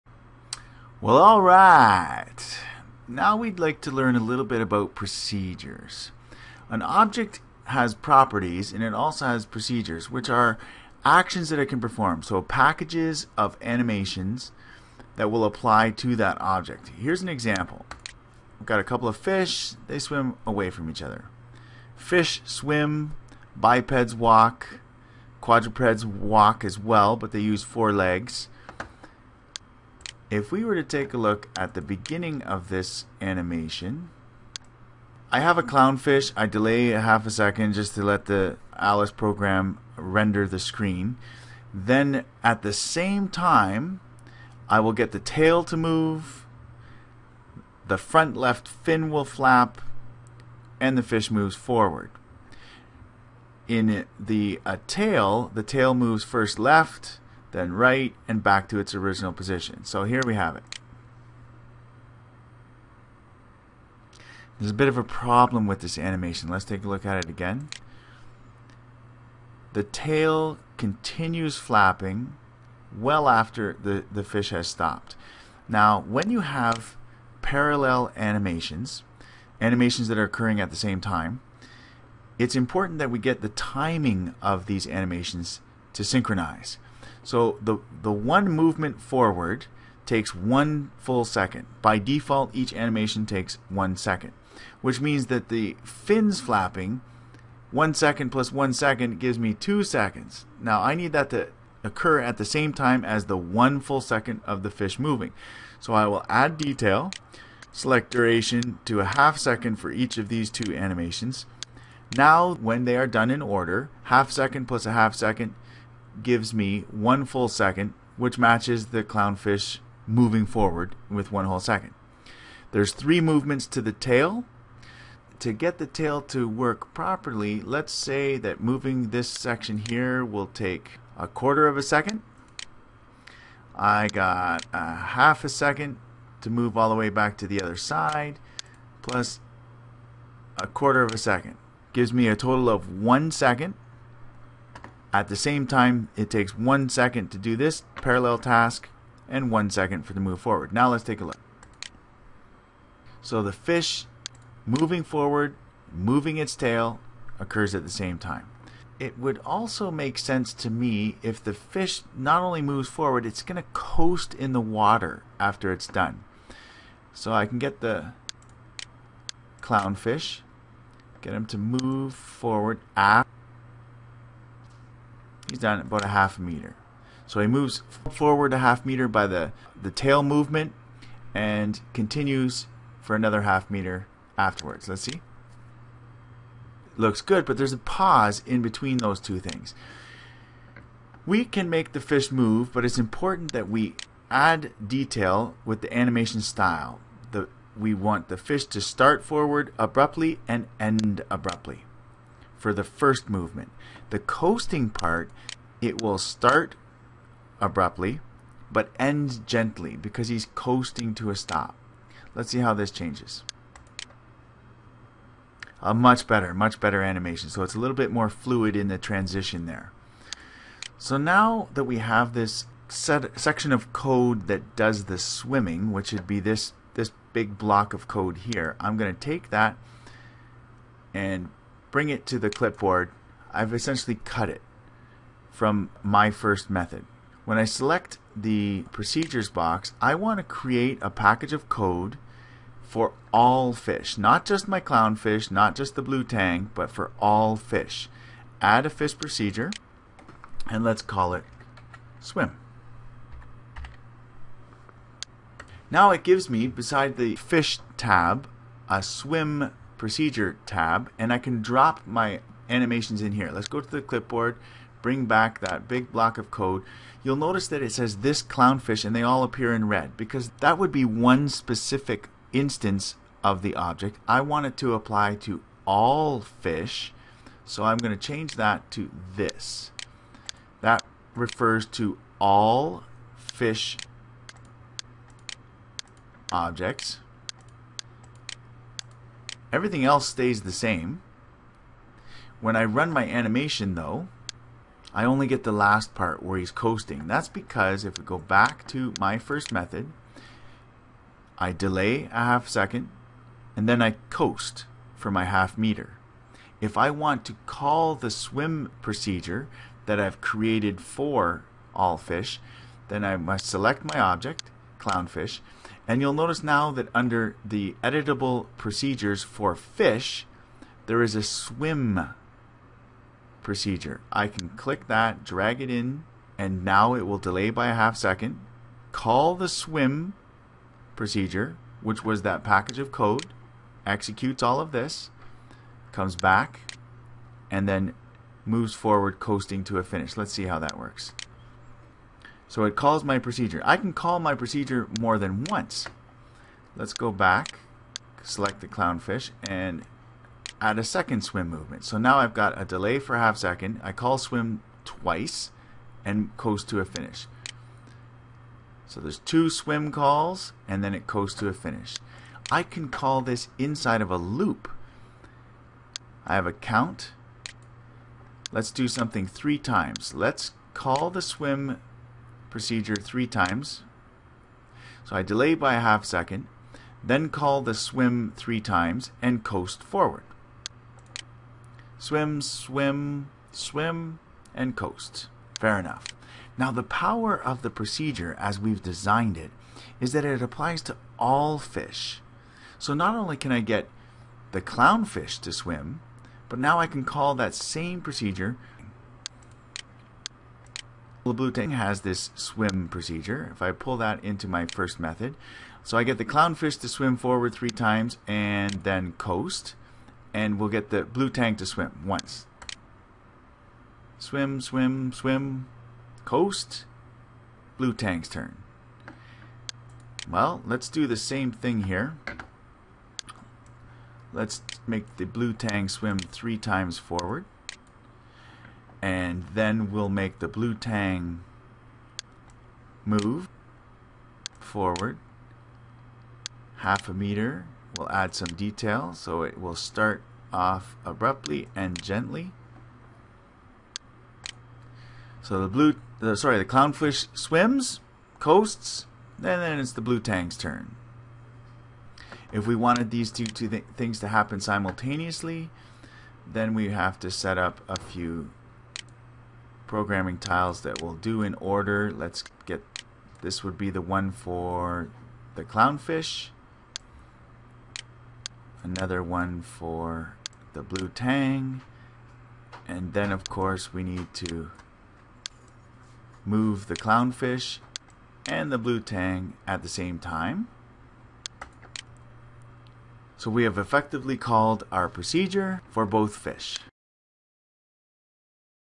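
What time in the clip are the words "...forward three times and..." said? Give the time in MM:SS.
06:47.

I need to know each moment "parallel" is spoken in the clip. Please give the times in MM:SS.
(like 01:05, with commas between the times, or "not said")
01:17, 02:27.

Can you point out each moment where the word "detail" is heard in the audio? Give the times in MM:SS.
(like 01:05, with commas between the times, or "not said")
01:46, 03:14, 07:18.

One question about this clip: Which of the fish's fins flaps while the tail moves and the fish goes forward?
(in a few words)
front left fin.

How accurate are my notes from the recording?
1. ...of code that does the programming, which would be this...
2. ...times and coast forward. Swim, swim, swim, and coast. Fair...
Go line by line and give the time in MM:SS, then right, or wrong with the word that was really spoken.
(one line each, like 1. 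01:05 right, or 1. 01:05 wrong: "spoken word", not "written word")
1. 03:43 wrong: "swimming", not "programming"
2. 06:18 right.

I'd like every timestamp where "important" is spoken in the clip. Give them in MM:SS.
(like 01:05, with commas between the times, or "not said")
01:22, 03:12.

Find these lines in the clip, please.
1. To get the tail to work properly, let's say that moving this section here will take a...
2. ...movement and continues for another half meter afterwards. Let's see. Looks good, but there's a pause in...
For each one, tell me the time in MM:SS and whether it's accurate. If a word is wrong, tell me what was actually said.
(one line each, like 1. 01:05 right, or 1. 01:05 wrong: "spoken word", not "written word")
1. 02:05 right
2. 03:00 right.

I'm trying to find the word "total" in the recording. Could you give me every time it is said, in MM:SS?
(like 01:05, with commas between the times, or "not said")
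02:22.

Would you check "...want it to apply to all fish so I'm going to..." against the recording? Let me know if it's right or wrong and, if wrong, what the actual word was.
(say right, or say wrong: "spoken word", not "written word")
right.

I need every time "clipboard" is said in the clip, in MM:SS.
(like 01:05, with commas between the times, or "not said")
03:52, 04:24.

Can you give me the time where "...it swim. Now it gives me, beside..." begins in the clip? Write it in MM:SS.
04:11.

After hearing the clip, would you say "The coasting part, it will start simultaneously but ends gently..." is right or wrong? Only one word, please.
wrong.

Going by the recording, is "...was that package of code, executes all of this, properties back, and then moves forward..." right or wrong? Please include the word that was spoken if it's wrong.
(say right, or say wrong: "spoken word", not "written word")
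wrong: "comes", not "properties".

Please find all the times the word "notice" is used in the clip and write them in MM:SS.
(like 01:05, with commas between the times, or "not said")
04:27, 05:16.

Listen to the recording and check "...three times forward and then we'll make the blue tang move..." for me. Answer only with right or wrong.
right.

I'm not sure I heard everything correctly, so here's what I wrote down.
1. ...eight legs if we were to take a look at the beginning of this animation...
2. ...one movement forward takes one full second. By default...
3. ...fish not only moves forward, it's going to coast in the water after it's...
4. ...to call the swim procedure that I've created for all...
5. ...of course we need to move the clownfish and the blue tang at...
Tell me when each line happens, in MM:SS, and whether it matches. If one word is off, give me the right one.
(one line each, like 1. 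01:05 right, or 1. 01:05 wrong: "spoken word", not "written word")
1. 00:27 wrong: "four", not "eight"
2. 01:28 right
3. 02:41 right
4. 05:07 right
5. 07:53 right.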